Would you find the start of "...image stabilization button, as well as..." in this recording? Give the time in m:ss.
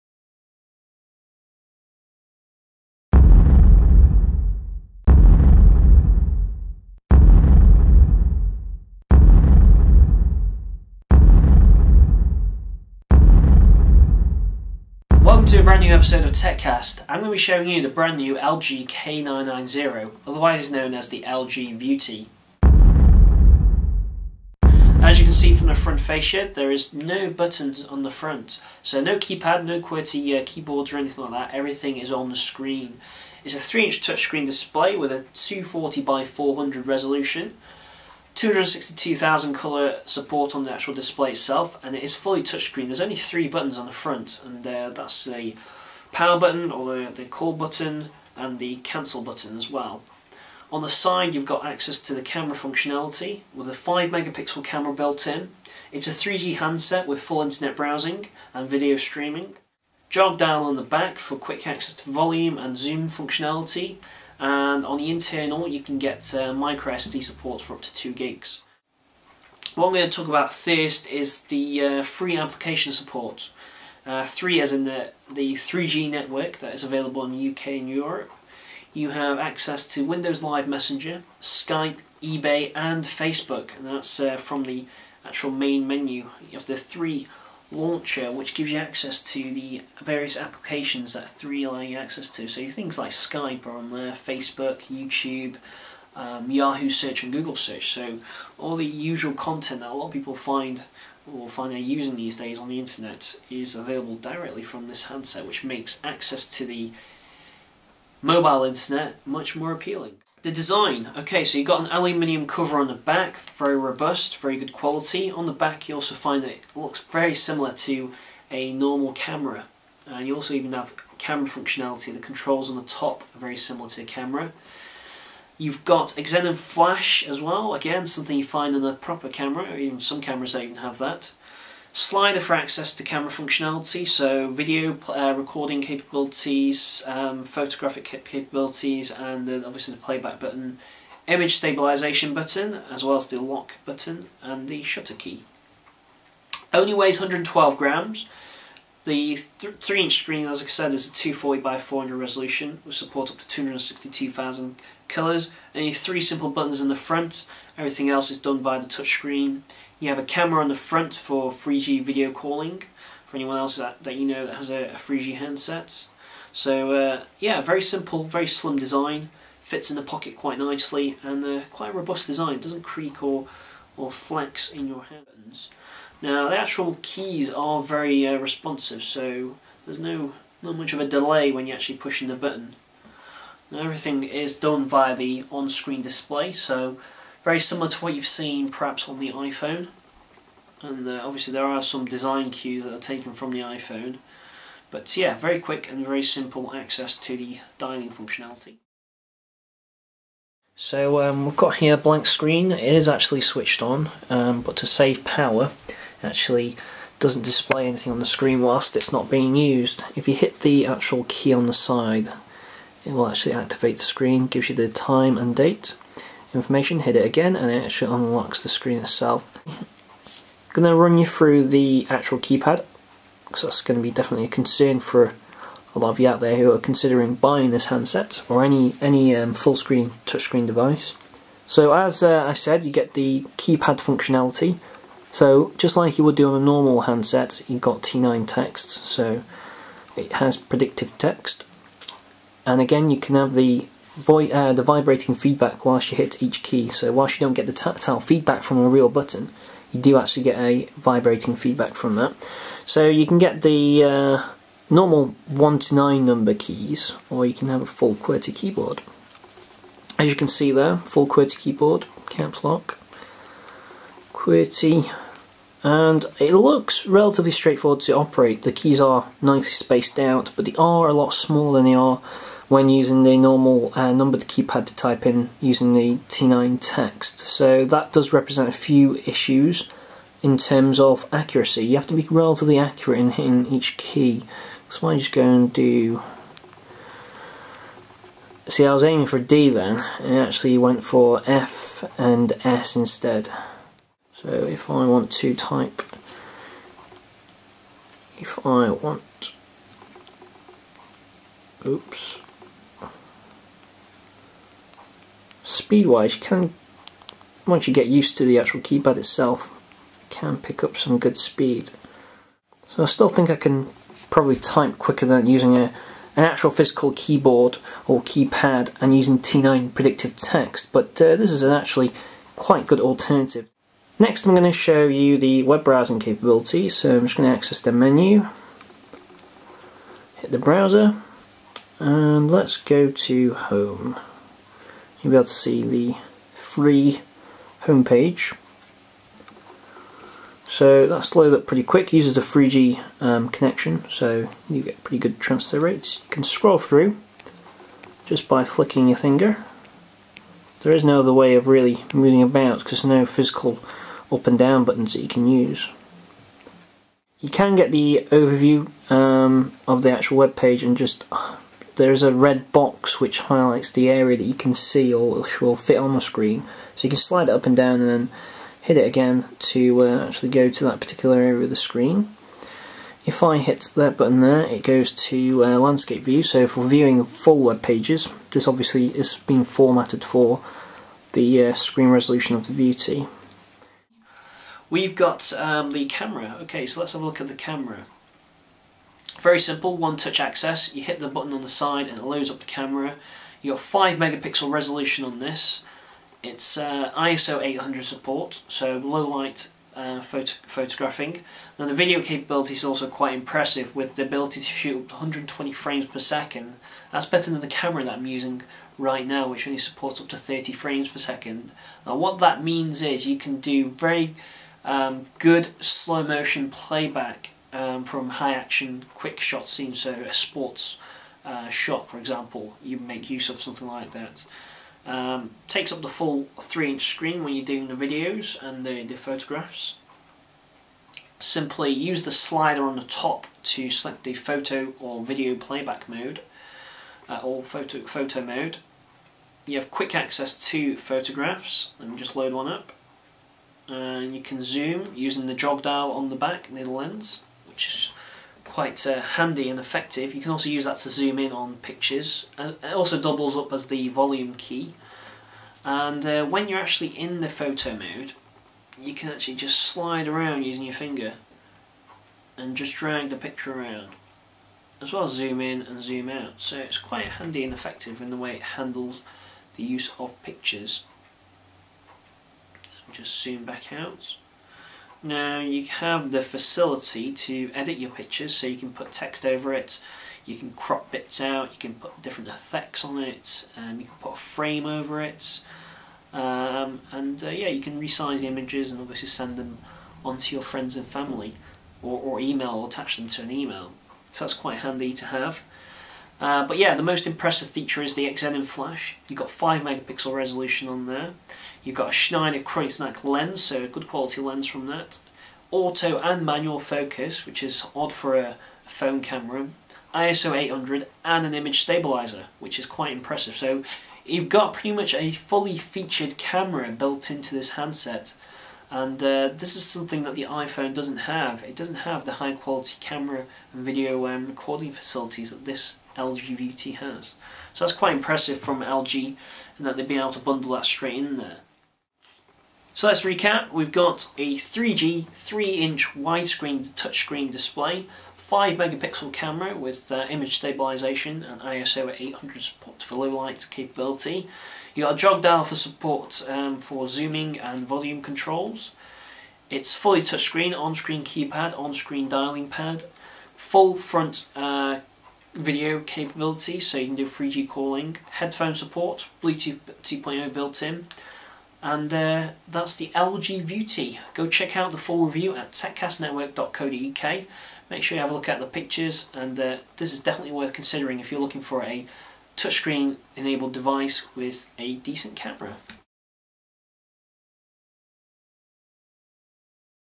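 2:21.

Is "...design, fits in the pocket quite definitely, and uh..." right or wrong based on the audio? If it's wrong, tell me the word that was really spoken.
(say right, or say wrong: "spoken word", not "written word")
wrong: "nicely", not "definitely".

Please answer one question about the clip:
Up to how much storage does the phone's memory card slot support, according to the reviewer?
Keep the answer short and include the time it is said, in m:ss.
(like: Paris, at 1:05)
2 gigs, at 1:07.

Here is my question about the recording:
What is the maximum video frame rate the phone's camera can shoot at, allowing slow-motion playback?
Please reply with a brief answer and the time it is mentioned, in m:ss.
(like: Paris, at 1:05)
120 frames per second, at 6:45.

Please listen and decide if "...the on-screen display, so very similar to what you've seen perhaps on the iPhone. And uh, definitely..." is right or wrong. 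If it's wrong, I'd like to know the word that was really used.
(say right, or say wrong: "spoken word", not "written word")
wrong: "obviously", not "definitely".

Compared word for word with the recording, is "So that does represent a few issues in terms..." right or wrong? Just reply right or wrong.
right.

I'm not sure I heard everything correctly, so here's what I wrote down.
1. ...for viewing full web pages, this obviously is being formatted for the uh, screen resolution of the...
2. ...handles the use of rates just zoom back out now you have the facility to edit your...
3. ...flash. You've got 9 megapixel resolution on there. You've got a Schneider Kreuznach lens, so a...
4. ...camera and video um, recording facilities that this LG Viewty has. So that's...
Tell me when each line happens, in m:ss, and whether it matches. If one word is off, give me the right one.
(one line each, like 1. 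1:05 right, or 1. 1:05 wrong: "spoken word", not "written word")
1. 6:16 right
2. 7:48 wrong: "pictures", not "rates"
3. 8:18 wrong: "5", not "9"
4. 8:42 right.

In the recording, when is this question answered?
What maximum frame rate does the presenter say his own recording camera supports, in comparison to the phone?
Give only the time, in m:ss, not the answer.
6:50.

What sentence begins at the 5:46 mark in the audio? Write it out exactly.
You can scroll through just by flicking your finger.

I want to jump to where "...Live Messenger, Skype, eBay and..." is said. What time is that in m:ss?
1:20.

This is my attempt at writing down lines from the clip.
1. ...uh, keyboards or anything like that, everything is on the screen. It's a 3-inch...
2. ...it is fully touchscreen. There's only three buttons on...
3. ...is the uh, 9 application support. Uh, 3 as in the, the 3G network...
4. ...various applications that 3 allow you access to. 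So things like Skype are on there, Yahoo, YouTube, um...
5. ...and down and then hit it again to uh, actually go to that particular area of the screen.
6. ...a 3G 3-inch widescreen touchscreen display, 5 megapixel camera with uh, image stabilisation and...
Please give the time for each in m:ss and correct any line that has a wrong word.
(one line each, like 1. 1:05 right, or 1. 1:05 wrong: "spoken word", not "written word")
1. 0:30 right
2. 0:41 right
3. 1:11 wrong: "3", not "9"
4. 1:30 wrong: "Facebook", not "Yahoo"
5. 6:07 right
6. 8:54 right.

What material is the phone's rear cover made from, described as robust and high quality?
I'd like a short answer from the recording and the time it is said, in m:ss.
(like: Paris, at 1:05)
Aluminium, at 1:51.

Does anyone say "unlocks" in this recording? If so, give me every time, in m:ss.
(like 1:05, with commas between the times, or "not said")
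3:38.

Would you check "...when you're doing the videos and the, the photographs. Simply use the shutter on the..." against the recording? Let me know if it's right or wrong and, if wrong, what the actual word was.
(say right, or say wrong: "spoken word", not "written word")
wrong: "slider", not "shutter".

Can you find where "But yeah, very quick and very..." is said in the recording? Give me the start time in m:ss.
3:14.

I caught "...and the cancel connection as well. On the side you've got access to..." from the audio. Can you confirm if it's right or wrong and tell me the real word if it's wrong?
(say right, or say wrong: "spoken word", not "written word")
wrong: "button", not "connection".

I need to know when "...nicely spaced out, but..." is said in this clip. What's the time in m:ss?
4:29.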